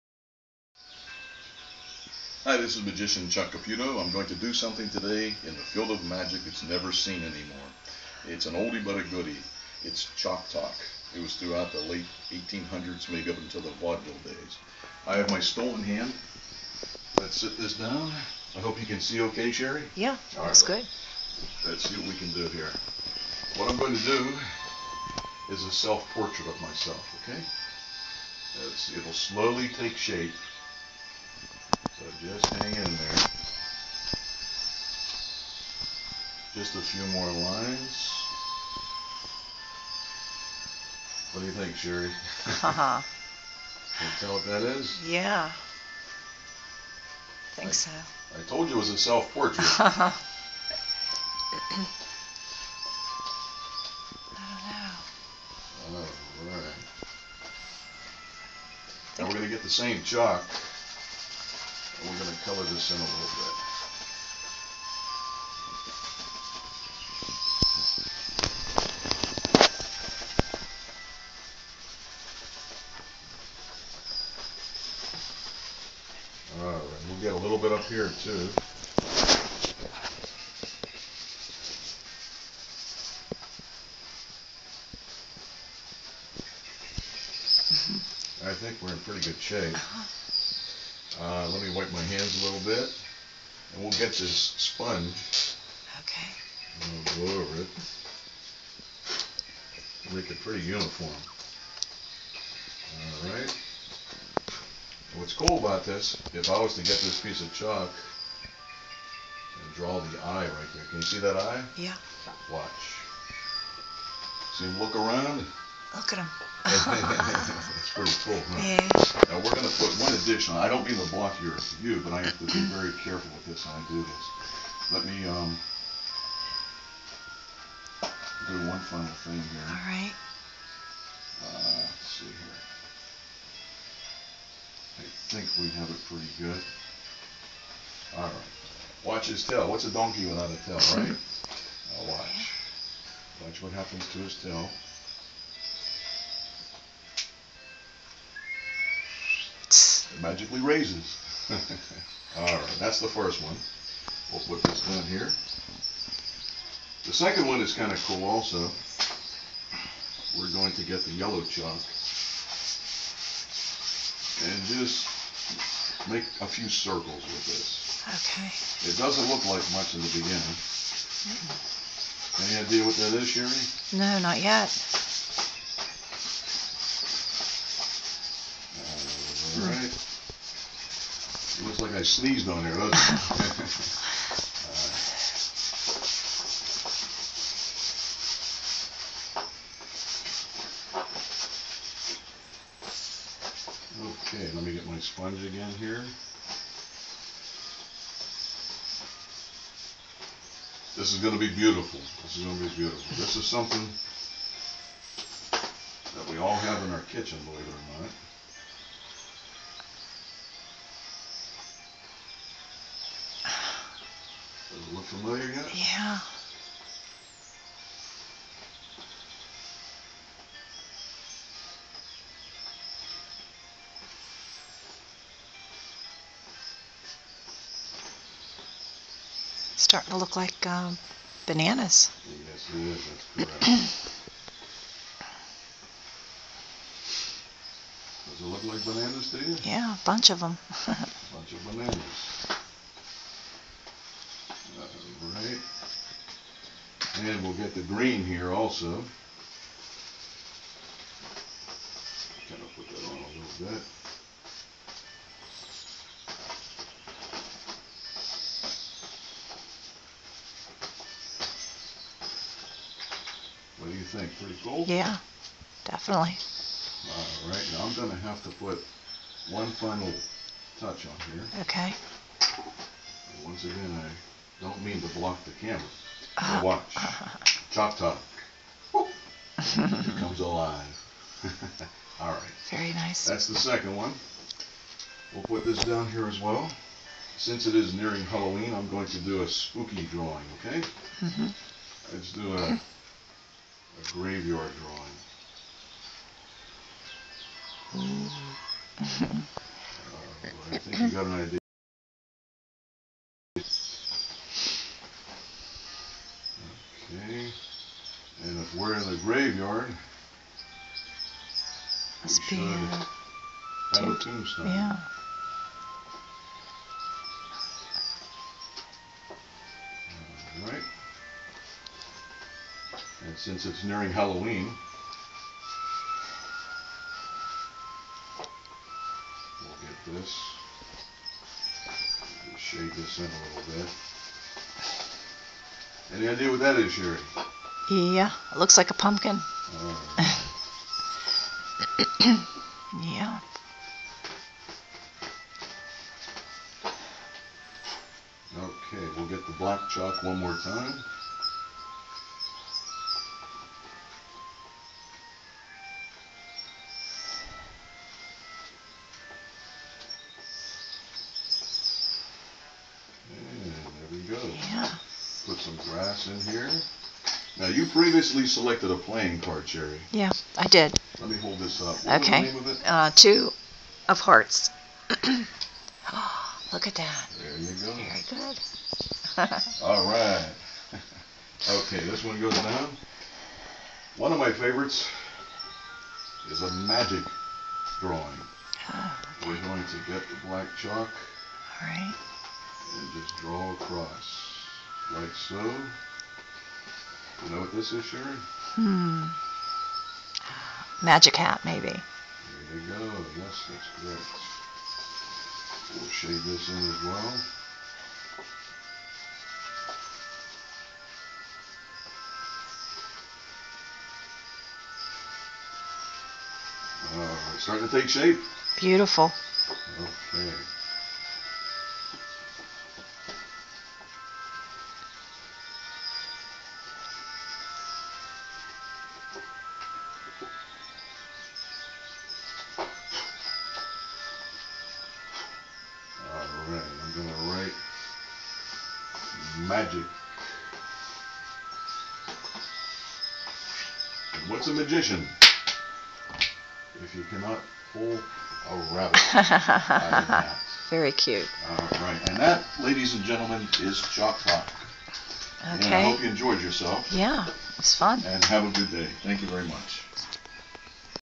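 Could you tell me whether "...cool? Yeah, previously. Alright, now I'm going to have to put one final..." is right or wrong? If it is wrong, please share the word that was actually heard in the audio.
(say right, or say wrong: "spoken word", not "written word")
wrong: "definitely", not "previously".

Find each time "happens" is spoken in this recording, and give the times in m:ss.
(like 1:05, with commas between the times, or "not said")
2:23.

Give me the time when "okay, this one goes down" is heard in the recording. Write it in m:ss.
6:21.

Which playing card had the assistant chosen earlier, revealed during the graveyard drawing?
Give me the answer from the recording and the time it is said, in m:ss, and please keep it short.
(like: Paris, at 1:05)
Two of hearts, at 6:13.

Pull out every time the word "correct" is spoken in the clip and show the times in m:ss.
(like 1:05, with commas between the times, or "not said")
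3:53, 6:43.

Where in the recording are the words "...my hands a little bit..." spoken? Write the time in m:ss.
1:31.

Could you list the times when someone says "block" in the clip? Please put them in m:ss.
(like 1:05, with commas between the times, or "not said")
2:01, 4:35.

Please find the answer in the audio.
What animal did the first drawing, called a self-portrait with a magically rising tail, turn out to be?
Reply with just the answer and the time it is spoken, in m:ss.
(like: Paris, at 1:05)
Donkey, at 2:19.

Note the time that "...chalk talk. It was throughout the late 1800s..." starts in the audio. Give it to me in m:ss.
0:10.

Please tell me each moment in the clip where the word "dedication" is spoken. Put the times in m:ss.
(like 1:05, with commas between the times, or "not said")
not said.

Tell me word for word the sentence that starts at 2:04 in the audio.
Let me um, do one final thing here.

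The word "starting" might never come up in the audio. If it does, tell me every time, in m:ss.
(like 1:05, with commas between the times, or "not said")
3:49, 6:57.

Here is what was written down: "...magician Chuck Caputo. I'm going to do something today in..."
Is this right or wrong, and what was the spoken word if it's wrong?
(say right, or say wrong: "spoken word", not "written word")
right.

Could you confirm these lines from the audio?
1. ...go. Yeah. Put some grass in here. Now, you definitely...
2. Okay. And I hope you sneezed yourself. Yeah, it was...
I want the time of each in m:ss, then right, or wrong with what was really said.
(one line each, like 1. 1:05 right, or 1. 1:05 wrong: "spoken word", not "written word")
1. 6:04 wrong: "previously", not "definitely"
2. 7:35 wrong: "enjoyed", not "sneezed".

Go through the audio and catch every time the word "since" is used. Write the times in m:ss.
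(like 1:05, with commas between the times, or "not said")
4:47, 5:23.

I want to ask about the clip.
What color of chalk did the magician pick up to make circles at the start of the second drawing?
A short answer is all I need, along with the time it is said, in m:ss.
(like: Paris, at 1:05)
Yellow, at 2:41.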